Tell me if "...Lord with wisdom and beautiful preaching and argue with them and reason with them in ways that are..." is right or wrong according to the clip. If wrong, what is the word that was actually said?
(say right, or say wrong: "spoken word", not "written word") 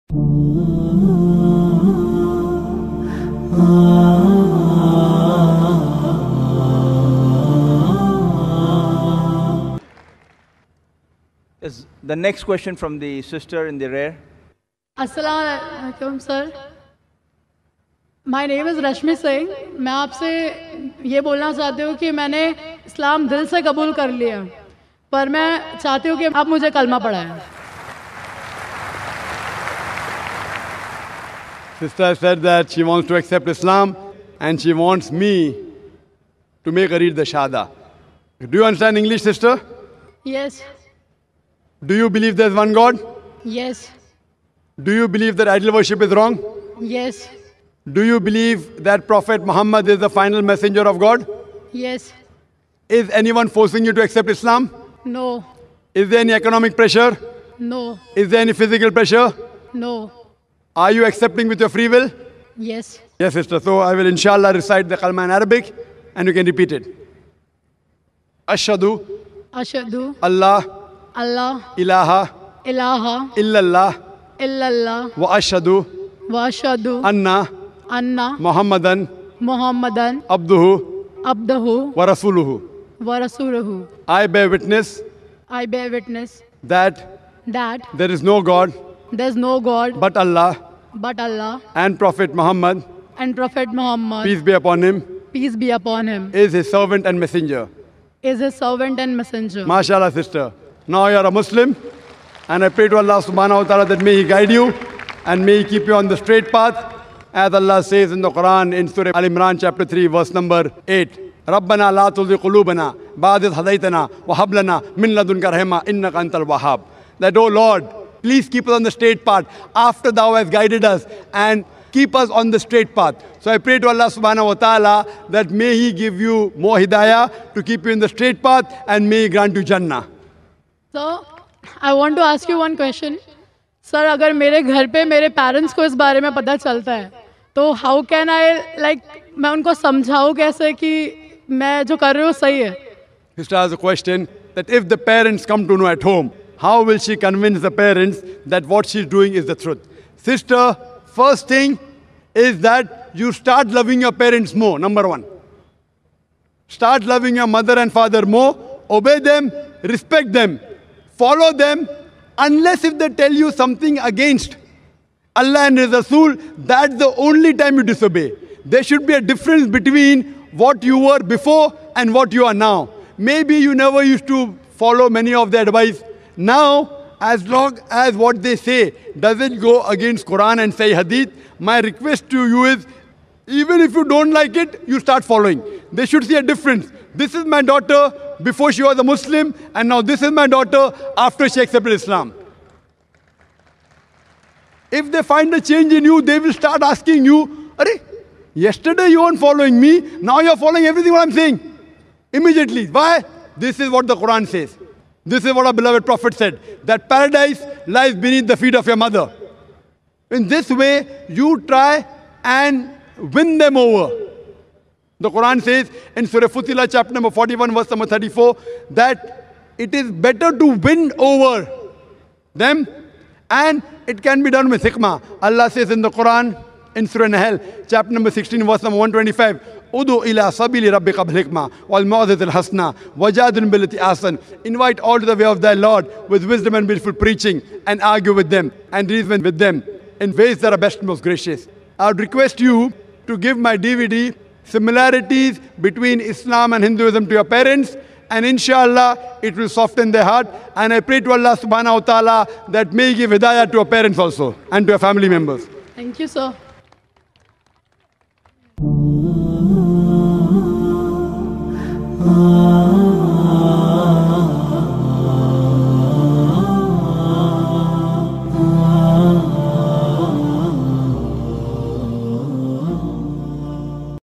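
right.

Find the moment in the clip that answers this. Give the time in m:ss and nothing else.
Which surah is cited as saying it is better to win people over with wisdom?
3:36.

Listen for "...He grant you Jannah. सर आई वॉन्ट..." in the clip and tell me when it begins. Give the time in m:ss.
2:09.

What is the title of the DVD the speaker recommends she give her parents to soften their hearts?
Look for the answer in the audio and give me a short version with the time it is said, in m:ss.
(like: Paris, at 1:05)
Similarities Between Islam and Hinduism, at 4:04.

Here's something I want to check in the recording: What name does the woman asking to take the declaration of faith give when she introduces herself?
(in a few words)
Rashmi Singh.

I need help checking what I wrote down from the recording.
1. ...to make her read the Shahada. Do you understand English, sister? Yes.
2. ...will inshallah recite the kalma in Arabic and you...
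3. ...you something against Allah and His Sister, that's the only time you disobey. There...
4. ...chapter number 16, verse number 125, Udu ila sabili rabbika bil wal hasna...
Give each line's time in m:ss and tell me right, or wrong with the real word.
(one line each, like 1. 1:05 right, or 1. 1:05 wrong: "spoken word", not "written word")
1. 0:36 right
2. 1:03 right
3. 2:43 wrong: "Rasul", not "Sister"
4. 3:47 right.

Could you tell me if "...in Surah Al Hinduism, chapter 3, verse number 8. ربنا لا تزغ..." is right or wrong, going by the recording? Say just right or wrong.
wrong.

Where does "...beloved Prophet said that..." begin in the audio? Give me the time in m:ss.
3:25.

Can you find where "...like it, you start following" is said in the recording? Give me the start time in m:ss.
3:04.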